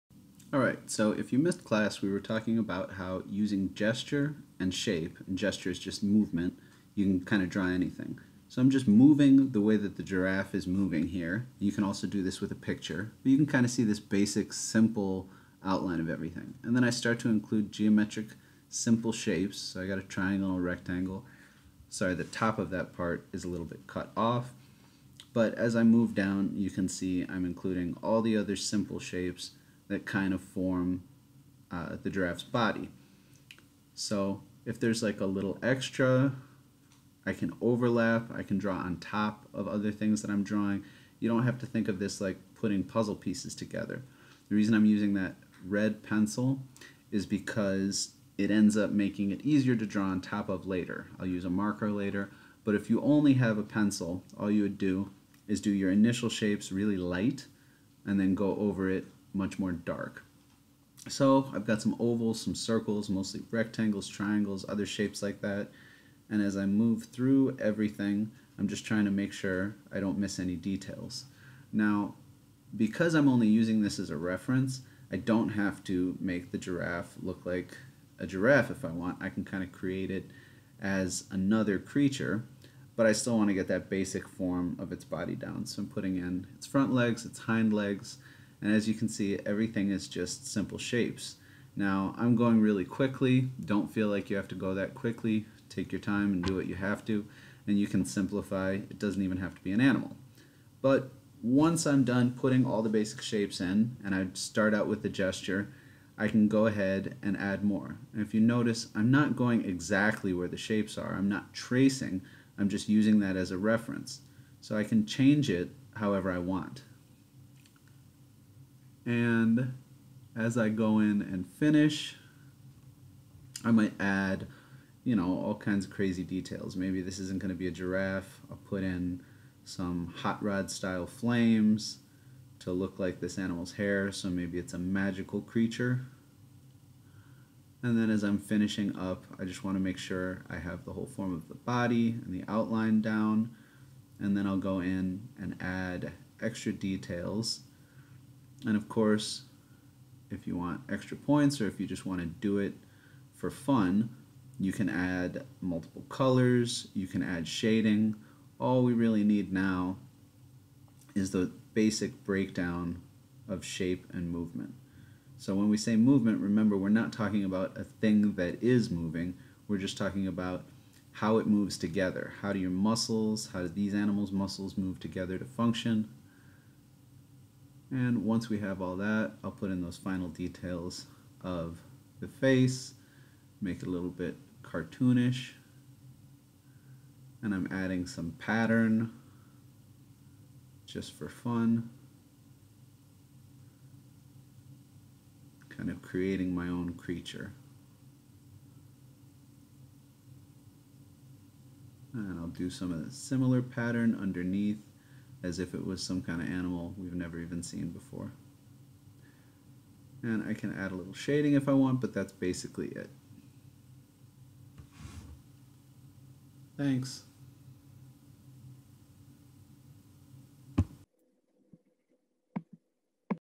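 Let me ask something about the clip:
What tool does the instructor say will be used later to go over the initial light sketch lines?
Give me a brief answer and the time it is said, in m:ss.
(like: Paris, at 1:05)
A marker, at 0:51.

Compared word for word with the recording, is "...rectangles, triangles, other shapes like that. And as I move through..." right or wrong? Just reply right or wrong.
right.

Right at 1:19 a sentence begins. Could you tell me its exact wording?
I can kind of create it as another creature, but I still want to get that basic form of its body down.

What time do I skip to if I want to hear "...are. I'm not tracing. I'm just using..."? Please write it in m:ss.
1:50.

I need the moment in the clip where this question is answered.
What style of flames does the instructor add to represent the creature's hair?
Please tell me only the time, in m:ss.
2:10.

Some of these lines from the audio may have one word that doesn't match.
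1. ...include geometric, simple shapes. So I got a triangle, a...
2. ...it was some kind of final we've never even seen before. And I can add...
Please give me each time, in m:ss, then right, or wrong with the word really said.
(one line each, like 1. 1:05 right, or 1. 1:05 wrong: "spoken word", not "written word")
1. 0:17 right
2. 3:25 wrong: "animal", not "final".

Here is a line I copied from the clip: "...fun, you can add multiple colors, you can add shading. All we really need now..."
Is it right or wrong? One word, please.
right.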